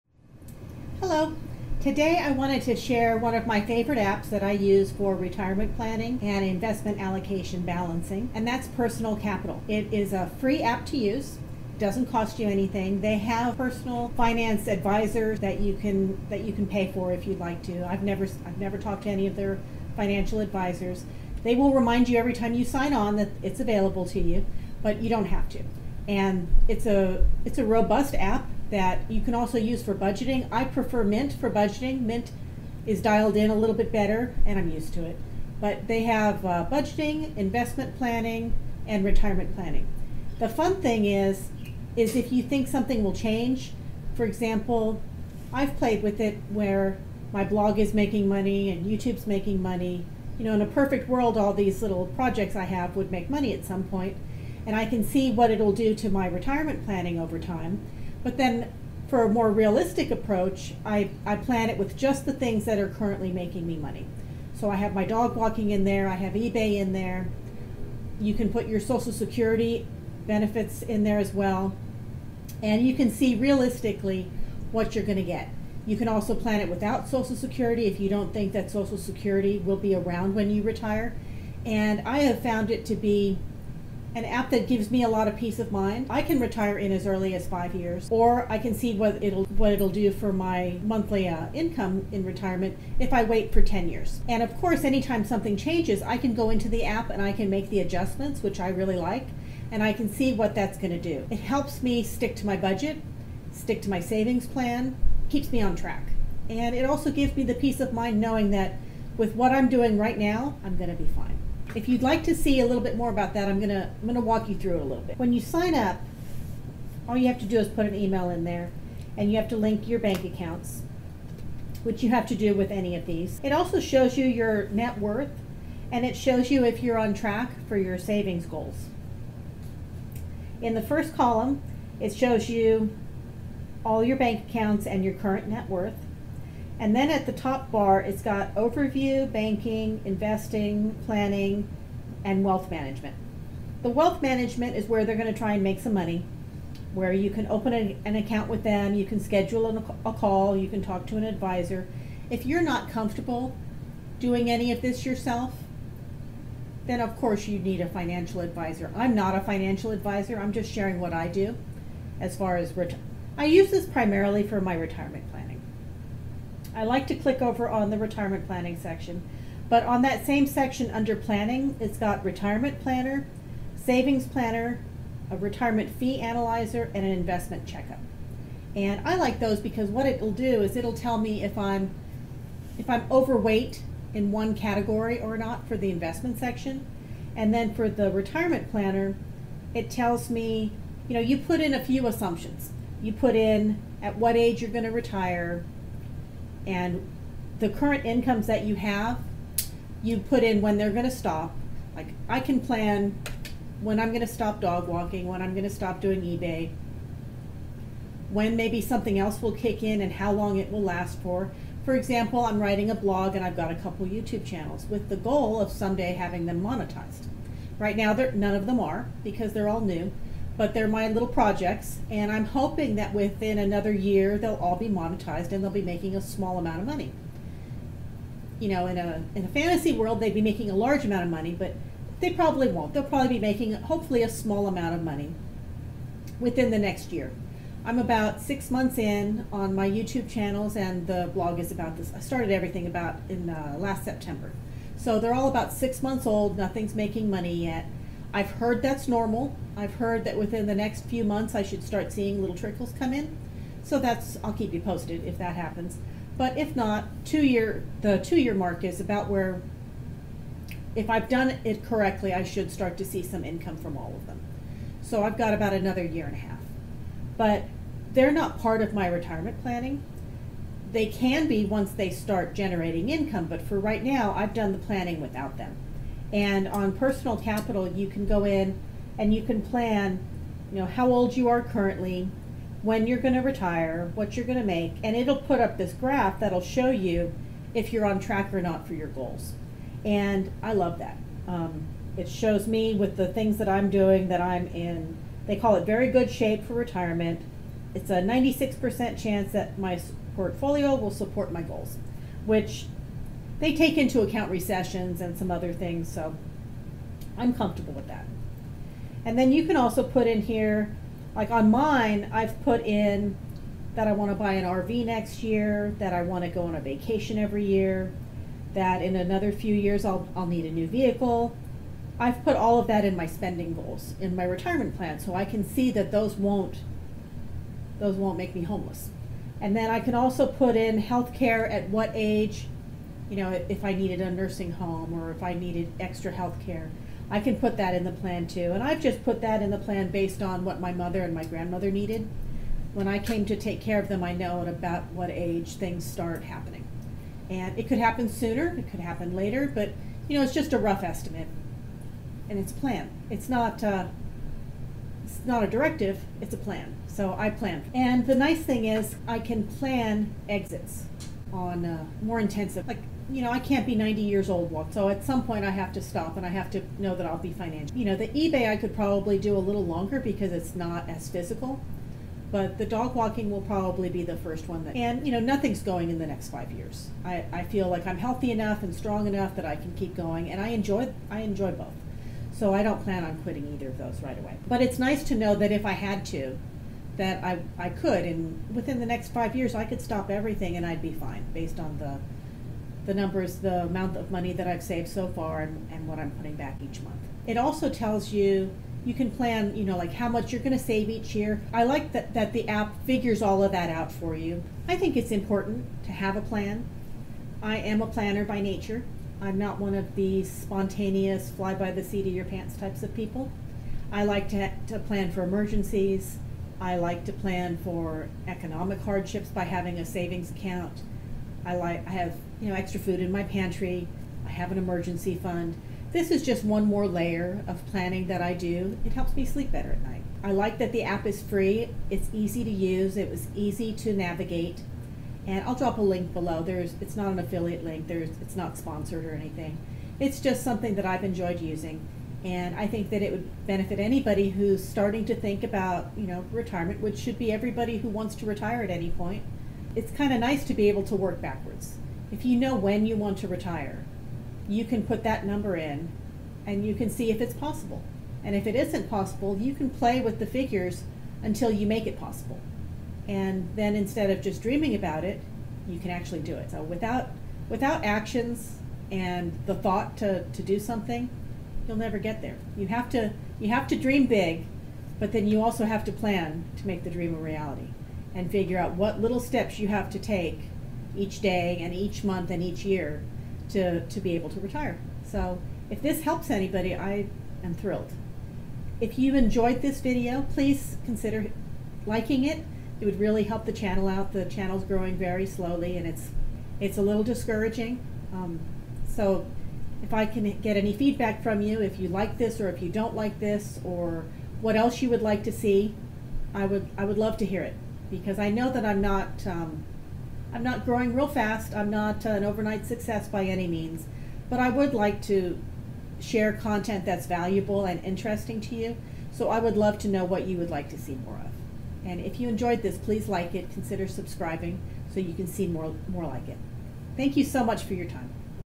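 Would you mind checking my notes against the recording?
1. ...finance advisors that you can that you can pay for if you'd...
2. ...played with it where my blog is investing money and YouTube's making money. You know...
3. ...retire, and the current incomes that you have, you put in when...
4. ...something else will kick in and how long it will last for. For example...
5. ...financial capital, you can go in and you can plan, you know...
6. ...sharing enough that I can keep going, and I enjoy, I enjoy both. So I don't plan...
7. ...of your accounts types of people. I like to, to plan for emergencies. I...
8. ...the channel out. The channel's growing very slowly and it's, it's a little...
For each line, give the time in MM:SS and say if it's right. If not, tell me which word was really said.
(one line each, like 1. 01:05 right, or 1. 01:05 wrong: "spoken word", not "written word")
1. 00:14 right
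2. 00:45 wrong: "making", not "investing"
3. 03:14 right
4. 03:28 right
5. 04:36 wrong: "personal", not "financial"
6. 06:18 wrong: "strong", not "sharing"
7. 06:52 wrong: "pants", not "accounts"
8. 08:13 right.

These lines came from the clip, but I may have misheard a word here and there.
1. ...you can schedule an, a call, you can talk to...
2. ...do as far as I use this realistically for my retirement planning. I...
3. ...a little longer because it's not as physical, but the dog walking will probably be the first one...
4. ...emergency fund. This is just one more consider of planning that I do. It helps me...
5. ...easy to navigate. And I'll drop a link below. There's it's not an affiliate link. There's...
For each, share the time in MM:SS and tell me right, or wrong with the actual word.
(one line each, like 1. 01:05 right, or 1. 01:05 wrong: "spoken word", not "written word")
1. 02:28 right
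2. 02:41 wrong: "primarily", not "realistically"
3. 06:09 right
4. 07:04 wrong: "layer", not "consider"
5. 07:13 right.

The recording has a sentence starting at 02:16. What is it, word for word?
And then at the top bar, it's got overview, banking, investing, planning, and wealth management.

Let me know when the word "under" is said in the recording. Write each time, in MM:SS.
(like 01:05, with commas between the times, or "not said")
02:50.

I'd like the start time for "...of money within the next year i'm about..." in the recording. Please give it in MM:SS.
03:54.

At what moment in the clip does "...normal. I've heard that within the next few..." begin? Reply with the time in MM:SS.
04:09.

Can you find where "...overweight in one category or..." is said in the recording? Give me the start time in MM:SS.
03:03.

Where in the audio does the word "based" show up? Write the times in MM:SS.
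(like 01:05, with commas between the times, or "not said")
05:40, 06:31.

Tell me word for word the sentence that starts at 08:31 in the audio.
I'm not an overnight success by any means, but I would like to share content that's valuable and interesting to you.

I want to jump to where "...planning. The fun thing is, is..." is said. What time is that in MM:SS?
00:39.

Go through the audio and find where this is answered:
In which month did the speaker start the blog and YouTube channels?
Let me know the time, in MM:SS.
04:04.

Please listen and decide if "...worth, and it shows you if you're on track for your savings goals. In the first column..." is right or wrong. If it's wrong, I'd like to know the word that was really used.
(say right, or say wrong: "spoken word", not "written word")
right.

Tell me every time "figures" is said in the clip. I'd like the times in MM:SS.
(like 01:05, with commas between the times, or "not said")
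06:43, 07:40, 07:58.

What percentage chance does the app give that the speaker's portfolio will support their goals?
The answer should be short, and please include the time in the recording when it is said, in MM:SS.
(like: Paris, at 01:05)
96%, at 04:58.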